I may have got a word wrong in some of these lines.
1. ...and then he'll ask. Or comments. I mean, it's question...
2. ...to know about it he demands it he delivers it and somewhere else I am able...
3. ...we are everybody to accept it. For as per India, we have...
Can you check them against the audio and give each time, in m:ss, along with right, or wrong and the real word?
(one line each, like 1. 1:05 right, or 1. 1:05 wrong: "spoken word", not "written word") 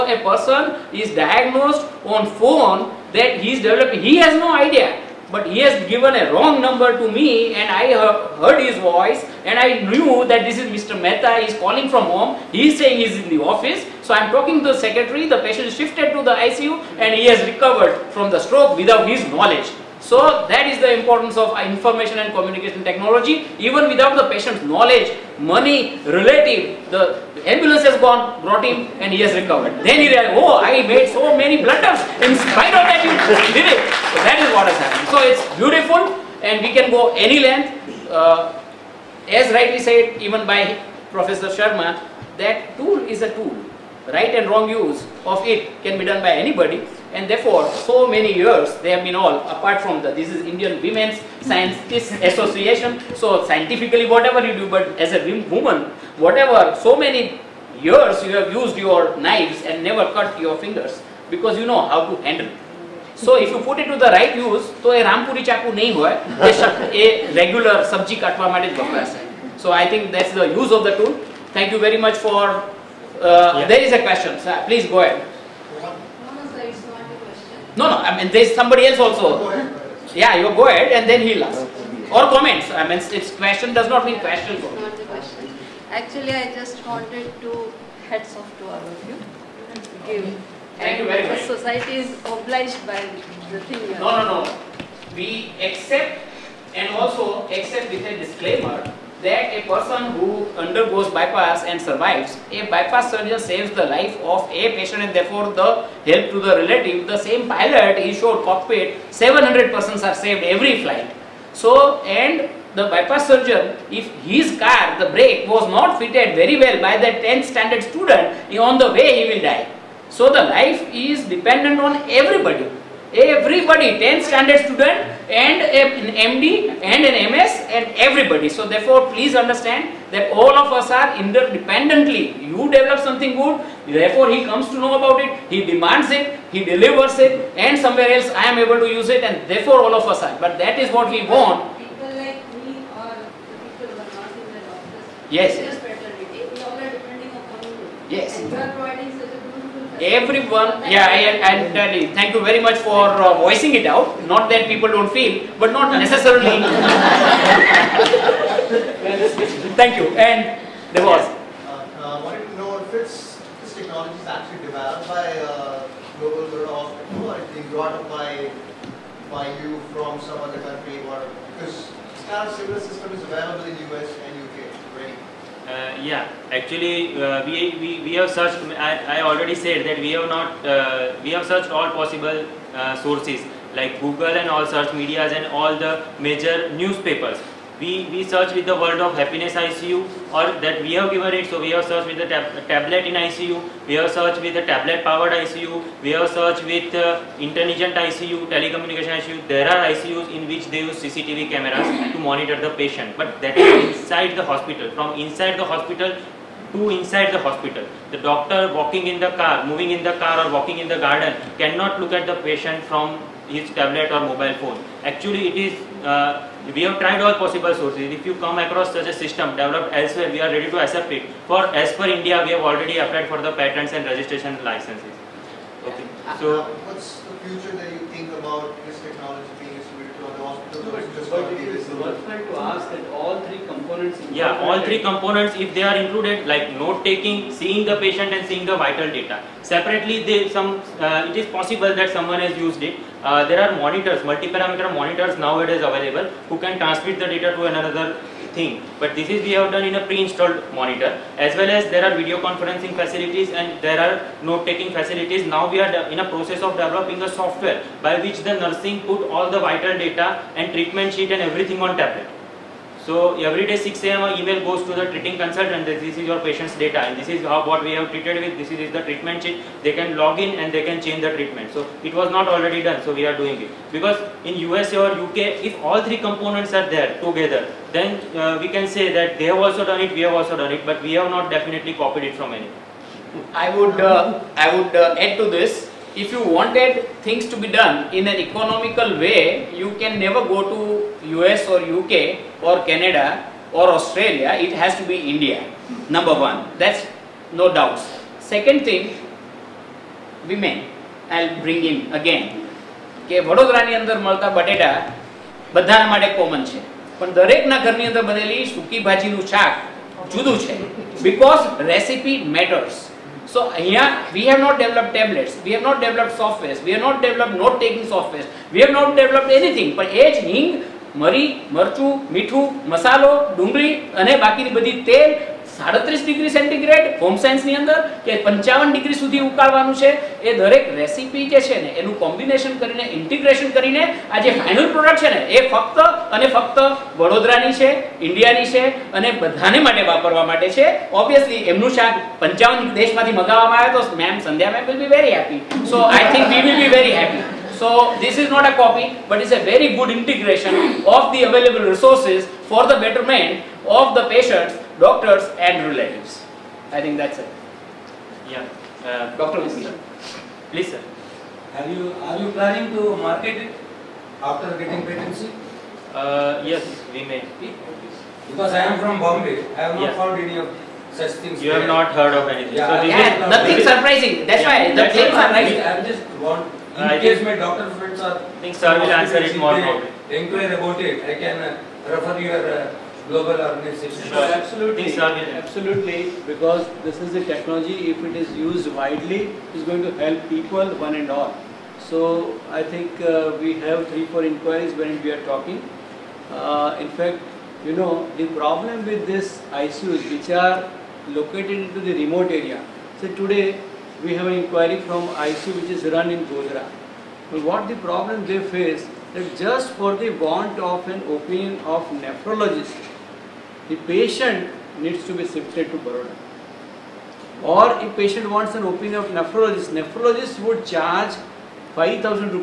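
1. 1:20 right
2. 2:14 right
3. 3:40 wrong: "ready", not "everybody".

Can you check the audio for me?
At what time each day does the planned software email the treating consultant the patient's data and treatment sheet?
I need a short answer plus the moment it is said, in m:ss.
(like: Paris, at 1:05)
6 a.m., at 4:23.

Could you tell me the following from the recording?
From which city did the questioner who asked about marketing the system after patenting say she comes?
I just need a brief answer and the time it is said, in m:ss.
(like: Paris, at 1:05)
Bombay, at 6:09.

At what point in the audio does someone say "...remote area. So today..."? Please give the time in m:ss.
6:42.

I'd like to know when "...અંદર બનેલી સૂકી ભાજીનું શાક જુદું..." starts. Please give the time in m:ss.
5:08.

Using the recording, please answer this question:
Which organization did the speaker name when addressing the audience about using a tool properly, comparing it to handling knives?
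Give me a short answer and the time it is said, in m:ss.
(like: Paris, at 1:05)
Indian Women's Scientists Association, at 0:50.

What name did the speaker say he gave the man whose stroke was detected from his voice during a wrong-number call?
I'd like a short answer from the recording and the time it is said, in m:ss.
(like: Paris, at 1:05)
Mr. Mehta, at 0:10.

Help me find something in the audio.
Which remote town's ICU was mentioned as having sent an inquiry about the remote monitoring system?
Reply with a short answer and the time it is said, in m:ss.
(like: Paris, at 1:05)
Godhra, at 6:46.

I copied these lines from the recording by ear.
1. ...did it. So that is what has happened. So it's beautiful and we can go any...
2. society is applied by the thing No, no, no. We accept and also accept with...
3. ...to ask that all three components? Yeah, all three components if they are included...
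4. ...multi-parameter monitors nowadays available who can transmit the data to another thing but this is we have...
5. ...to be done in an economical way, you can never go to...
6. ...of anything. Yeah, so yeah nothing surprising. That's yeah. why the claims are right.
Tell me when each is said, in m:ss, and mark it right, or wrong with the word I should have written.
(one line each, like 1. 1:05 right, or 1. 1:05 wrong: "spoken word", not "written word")
1. 0:33 right
2. 1:31 wrong: "obliged", not "applied"
3. 3:52 right
4. 4:04 right
5. 4:47 right
6. 6:12 right.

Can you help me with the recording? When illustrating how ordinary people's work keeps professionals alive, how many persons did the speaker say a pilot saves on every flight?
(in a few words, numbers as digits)
700.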